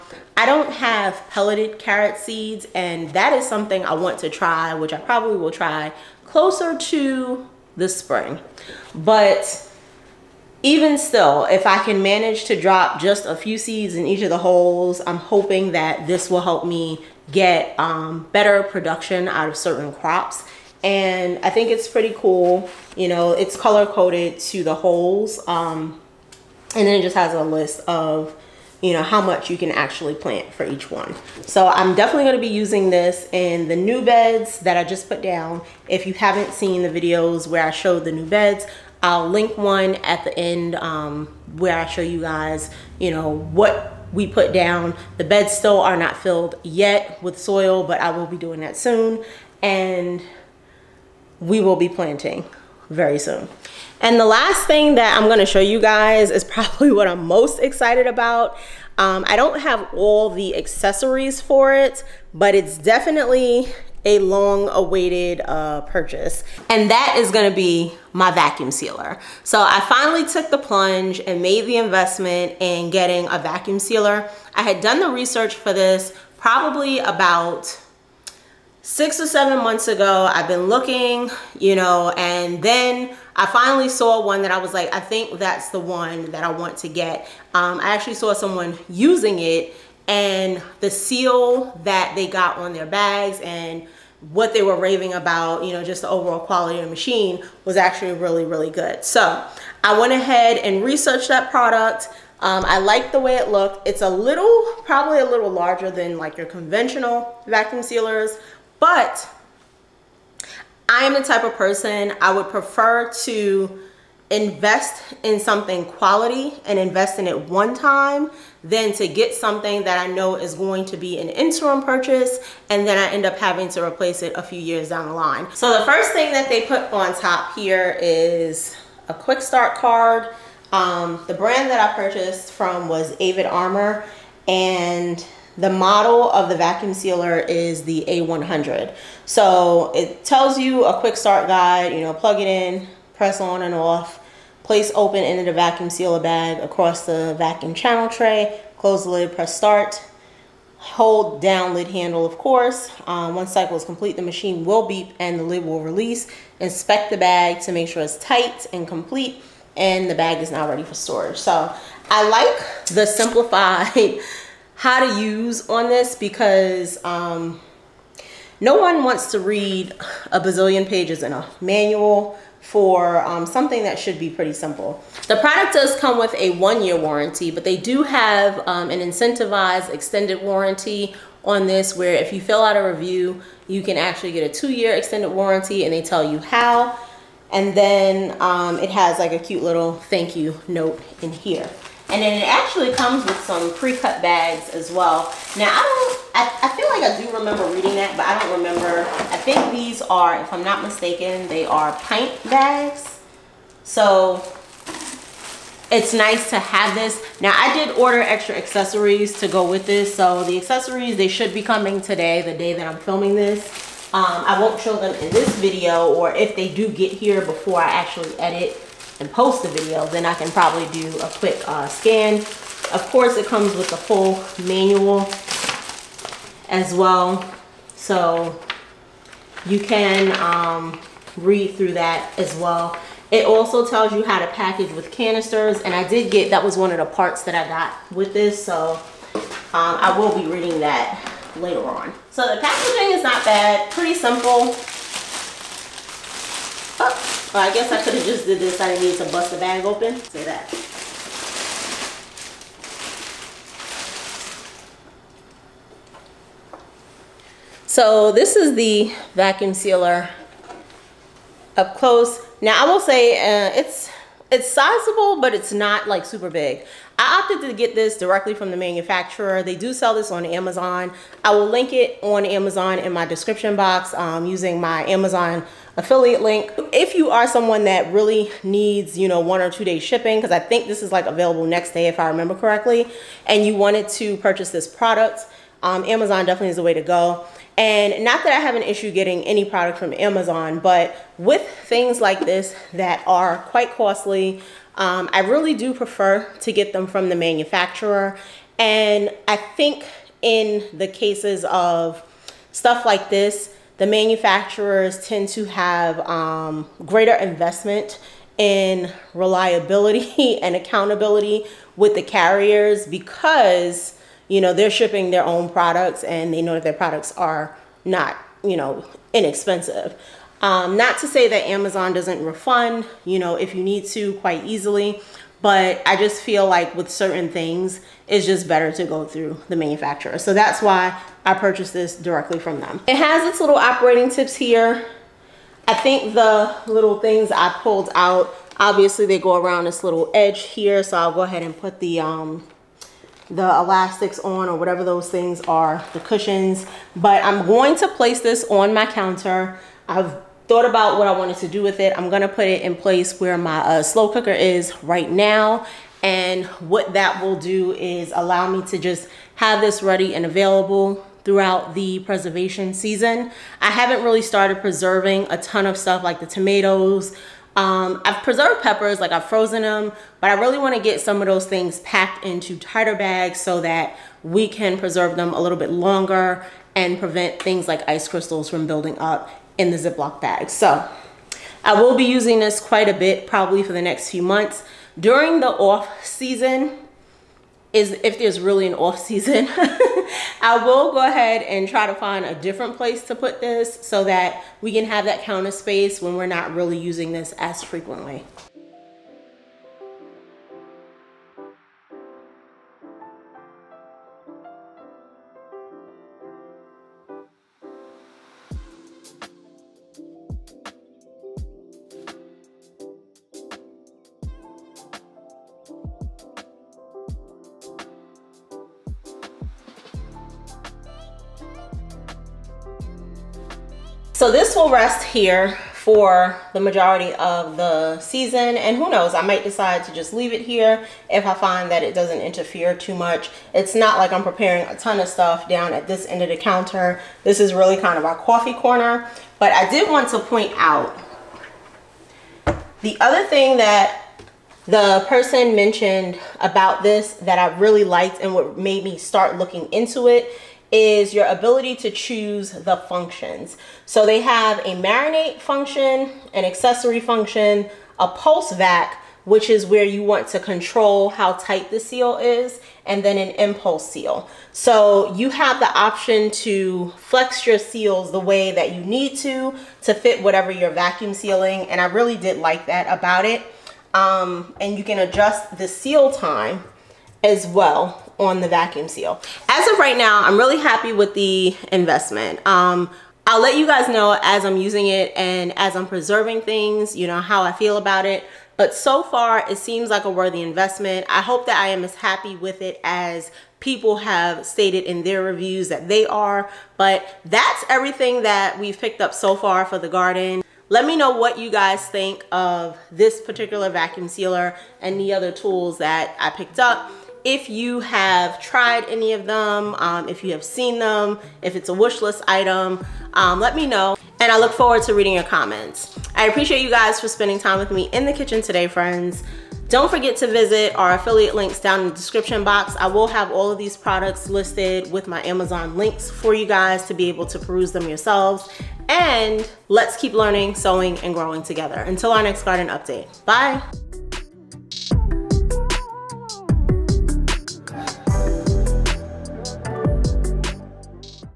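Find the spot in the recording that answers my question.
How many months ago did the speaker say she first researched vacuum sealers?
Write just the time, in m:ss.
1:18.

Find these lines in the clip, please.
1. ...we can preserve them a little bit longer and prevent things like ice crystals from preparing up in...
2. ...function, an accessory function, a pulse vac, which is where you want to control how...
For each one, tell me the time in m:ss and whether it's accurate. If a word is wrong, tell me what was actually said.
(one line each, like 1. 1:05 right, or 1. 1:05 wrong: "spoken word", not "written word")
1. 6:14 wrong: "building", not "preparing"
2. 7:35 right.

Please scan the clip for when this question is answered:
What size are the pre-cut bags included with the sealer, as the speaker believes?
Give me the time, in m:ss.
3:22.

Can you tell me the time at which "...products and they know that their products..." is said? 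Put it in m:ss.
5:15.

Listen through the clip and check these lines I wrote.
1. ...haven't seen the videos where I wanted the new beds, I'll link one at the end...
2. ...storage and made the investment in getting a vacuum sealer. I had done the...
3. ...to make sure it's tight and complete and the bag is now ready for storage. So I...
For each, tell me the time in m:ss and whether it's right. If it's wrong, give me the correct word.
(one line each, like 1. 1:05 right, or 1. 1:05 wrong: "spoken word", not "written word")
1. 0:36 wrong: "showed", not "wanted"
2. 1:10 wrong: "plunge", not "storage"
3. 2:37 right.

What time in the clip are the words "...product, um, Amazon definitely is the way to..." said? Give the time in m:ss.
4:44.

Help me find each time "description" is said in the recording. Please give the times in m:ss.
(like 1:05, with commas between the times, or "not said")
4:33, 8:42.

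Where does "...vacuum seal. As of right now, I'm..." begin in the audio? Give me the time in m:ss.
7:58.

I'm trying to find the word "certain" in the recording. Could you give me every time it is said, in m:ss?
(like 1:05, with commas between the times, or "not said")
0:19, 5:27.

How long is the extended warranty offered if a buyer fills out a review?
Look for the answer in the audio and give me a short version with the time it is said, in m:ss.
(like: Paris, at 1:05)
2 years, at 3:04.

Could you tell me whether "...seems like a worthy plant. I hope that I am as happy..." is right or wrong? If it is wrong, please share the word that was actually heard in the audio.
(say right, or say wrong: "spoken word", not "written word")
wrong: "investment", not "plant".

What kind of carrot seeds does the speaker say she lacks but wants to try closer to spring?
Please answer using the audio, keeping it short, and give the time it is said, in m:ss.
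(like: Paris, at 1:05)
Pelleted, at 0:01.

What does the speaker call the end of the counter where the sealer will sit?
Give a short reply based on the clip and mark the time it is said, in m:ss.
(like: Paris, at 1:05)
Coffee corner, at 7:18.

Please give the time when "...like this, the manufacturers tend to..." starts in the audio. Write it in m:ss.
5:03.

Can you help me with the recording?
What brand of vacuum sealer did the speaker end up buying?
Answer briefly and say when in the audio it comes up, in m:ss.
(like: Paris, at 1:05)
Avid Armor, at 2:13.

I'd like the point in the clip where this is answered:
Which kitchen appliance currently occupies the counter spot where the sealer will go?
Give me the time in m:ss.
5:54.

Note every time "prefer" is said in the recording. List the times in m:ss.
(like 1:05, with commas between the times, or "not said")
1:52, 4:55.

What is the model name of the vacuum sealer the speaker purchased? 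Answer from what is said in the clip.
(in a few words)
A100.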